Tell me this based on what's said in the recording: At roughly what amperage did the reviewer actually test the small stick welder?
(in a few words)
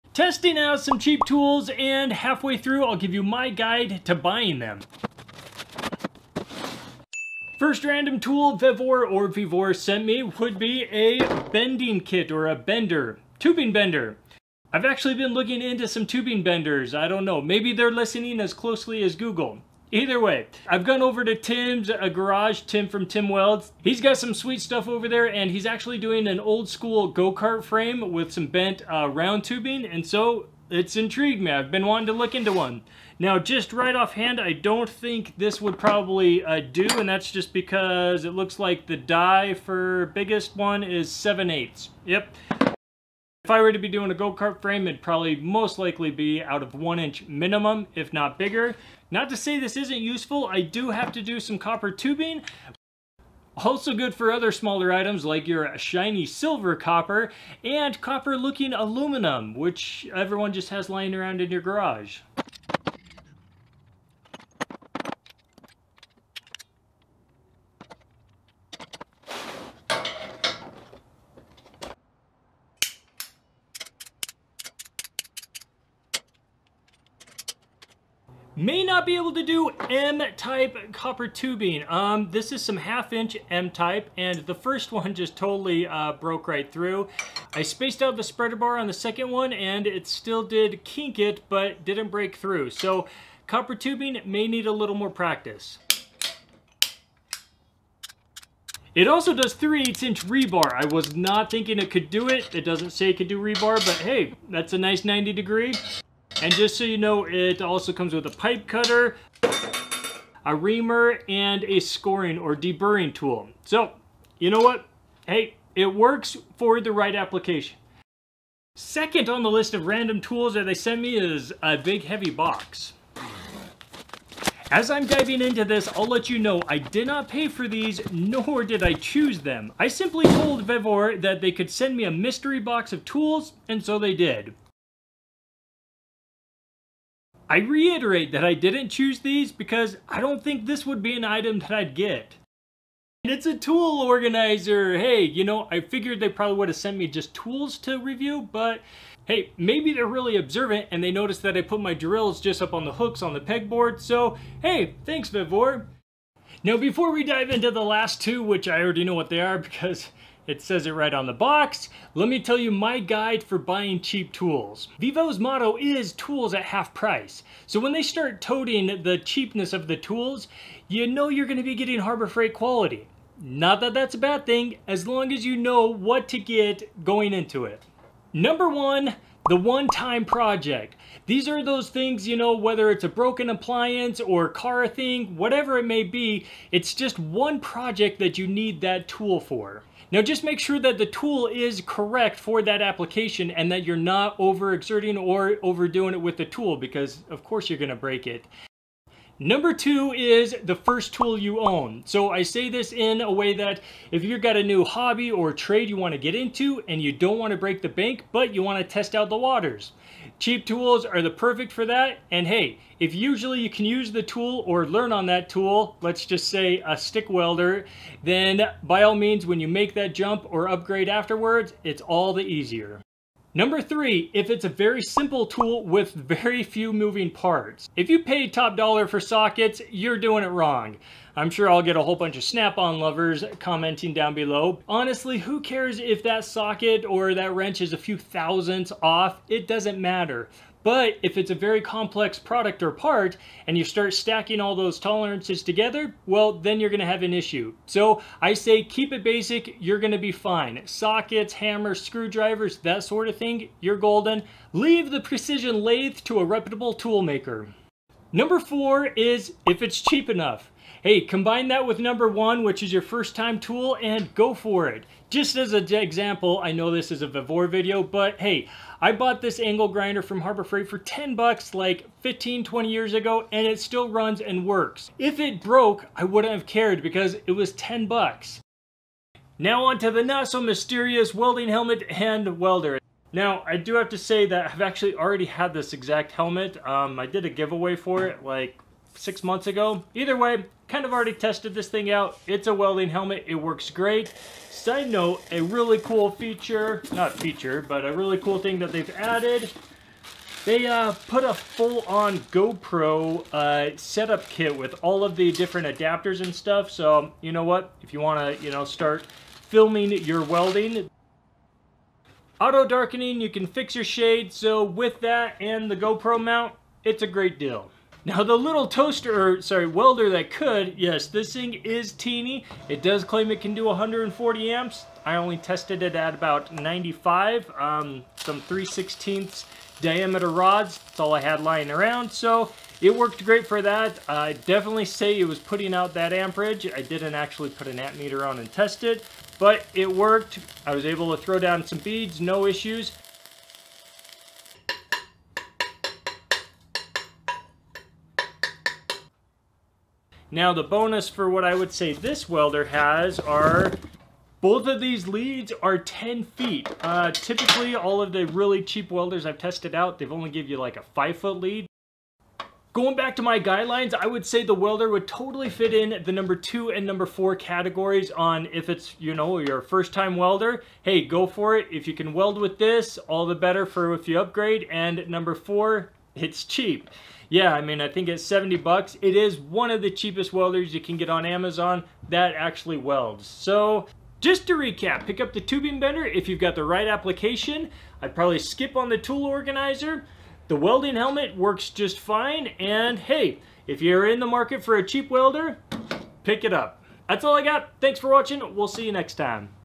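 95.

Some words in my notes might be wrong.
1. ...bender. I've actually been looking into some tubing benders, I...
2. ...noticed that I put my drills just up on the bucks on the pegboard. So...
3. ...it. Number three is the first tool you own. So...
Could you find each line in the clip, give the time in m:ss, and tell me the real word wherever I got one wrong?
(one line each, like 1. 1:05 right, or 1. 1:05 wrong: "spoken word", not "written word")
1. 0:13 right
2. 2:31 wrong: "hooks", not "bucks"
3. 3:18 wrong: "two", not "three".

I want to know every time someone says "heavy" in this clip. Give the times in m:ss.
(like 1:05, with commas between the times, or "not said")
2:02.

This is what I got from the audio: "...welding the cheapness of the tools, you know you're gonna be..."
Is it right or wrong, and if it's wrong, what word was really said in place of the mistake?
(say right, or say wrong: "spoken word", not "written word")
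wrong: "toting", not "welding".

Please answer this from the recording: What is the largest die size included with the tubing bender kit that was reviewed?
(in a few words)
7/8 inch.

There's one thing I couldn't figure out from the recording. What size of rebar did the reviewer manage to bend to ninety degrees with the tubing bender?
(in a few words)
3/8 inch.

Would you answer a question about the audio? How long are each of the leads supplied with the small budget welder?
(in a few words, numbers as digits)
10 feet.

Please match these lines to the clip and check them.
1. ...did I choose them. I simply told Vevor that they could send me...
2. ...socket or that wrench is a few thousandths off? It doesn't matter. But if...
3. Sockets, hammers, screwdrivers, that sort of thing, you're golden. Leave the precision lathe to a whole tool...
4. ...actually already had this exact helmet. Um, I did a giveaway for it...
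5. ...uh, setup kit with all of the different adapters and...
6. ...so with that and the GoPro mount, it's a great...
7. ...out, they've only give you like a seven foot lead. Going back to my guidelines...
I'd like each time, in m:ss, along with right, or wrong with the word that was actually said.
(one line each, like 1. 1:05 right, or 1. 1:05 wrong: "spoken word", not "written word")
1. 2:08 right
2. 3:56 right
3. 4:10 wrong: "reputable", not "whole"
4. 4:44 right
5. 5:03 right
6. 5:14 right
7. 5:59 wrong: "five", not "seven".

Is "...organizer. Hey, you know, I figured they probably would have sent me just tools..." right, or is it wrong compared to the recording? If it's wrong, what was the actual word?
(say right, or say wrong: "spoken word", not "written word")
right.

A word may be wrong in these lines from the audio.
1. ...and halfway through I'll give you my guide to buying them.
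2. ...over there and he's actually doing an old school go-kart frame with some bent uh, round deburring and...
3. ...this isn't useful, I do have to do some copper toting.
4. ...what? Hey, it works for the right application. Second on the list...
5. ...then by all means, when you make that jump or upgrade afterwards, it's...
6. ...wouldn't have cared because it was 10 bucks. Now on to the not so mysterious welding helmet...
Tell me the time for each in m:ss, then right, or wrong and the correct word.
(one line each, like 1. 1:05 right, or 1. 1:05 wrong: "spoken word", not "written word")
1. 0:01 right
2. 0:24 wrong: "tubing", not "deburring"
3. 0:49 wrong: "tubing", not "toting"
4. 1:54 right
5. 3:38 right
6. 4:36 right.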